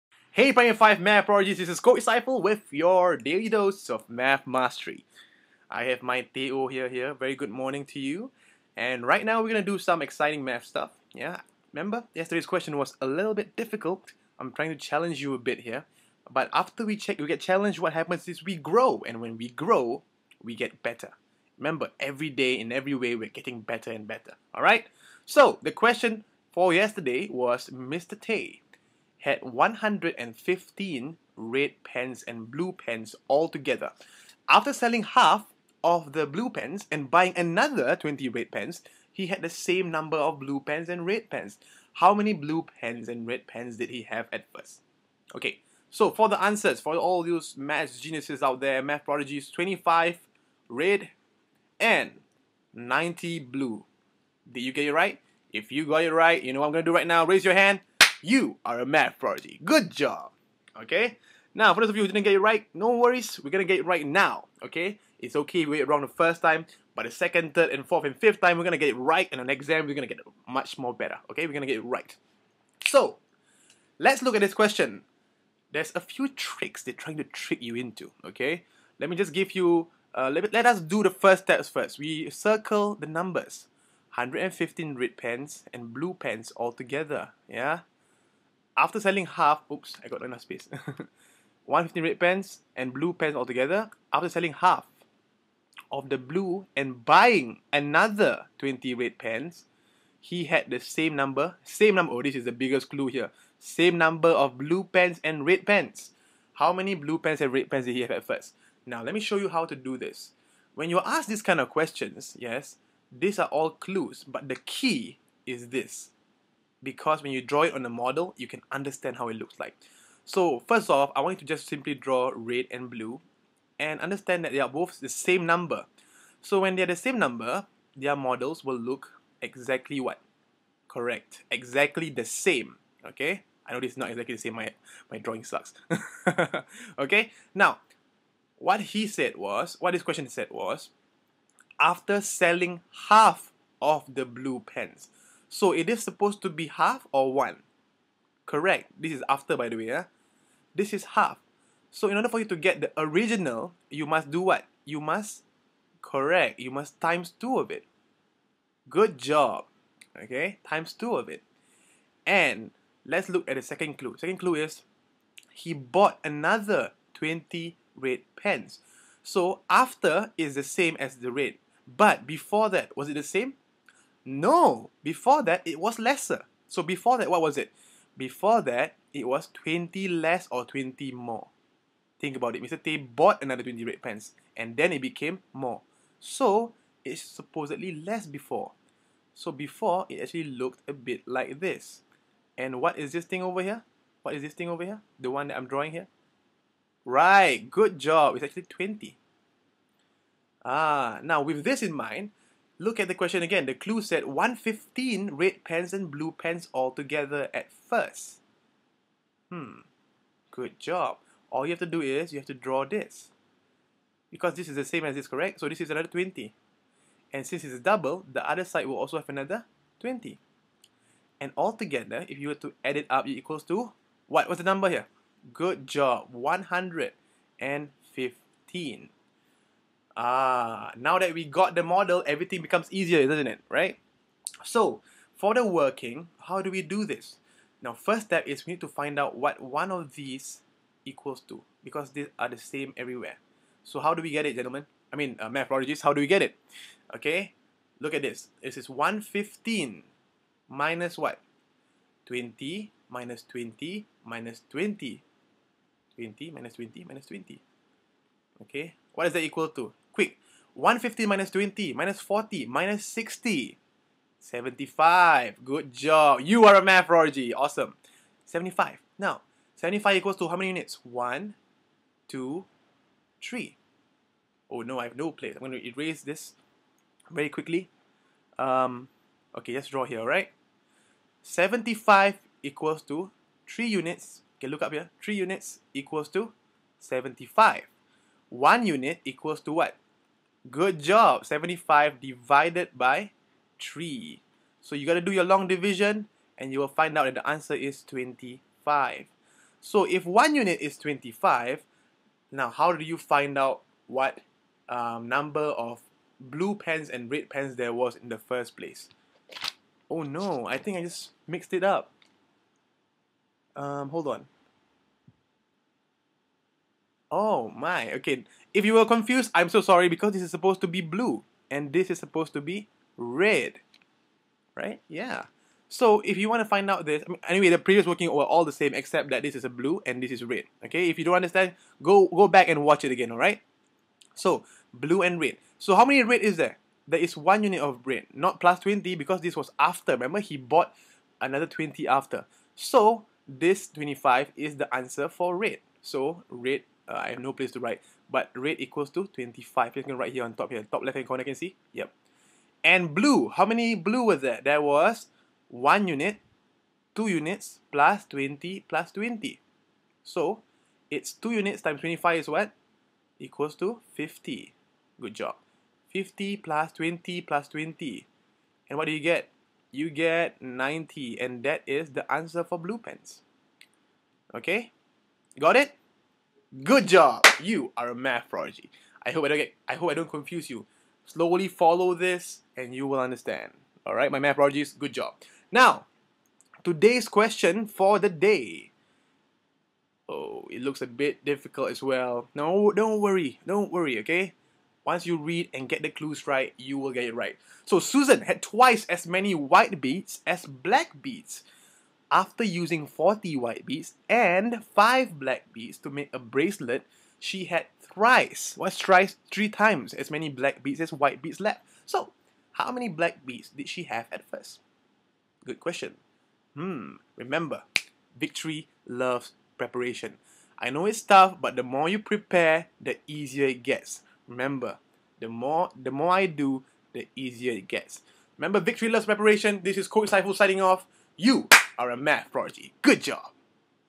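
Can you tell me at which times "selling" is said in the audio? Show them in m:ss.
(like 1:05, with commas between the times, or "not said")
0:34, 1:28, 1:34, 2:22.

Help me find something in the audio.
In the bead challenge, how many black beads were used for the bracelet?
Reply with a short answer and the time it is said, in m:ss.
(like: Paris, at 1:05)
5, at 6:44.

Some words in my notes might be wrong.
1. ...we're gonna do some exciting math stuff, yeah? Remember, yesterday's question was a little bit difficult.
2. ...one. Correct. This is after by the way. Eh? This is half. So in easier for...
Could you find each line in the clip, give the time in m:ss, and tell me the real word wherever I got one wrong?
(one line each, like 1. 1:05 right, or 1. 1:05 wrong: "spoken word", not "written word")
1. 0:09 right
2. 2:27 wrong: "order", not "easier".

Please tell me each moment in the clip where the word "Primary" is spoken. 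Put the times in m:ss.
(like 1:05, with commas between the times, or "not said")
0:00.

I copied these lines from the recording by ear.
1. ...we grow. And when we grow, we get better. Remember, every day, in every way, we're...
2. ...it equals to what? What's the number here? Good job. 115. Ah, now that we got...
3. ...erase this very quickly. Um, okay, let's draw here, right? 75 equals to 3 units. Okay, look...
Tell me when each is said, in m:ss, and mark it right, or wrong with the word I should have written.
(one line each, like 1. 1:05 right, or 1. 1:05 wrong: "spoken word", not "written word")
1. 0:18 right
2. 3:43 right
3. 4:35 right.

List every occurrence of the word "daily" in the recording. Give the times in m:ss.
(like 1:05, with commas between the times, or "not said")
0:03.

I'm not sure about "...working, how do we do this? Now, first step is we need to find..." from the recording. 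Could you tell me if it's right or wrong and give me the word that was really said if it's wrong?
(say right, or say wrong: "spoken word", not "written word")
right.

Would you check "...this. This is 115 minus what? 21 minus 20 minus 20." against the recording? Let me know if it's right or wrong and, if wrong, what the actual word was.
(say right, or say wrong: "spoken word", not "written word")
wrong: "20", not "21".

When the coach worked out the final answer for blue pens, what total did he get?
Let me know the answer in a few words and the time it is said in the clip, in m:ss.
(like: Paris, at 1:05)
90, at 6:09.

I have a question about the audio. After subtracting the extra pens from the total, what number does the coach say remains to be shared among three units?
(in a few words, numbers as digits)
75.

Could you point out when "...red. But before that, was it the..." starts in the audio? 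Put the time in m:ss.
2:51.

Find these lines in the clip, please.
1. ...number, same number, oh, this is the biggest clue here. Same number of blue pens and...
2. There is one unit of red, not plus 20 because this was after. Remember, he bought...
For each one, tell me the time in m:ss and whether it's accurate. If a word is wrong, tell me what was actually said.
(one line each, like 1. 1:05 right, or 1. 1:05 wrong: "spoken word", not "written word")
1. 1:41 right
2. 5:37 right.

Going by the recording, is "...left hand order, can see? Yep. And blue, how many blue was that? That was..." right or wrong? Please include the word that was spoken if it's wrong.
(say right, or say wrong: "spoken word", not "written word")
wrong: "corner", not "order".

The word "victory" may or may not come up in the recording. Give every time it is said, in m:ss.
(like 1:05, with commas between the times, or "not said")
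6:58, 7:08.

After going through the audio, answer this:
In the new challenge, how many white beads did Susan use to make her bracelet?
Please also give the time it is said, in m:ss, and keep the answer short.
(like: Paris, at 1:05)
40, at 6:43.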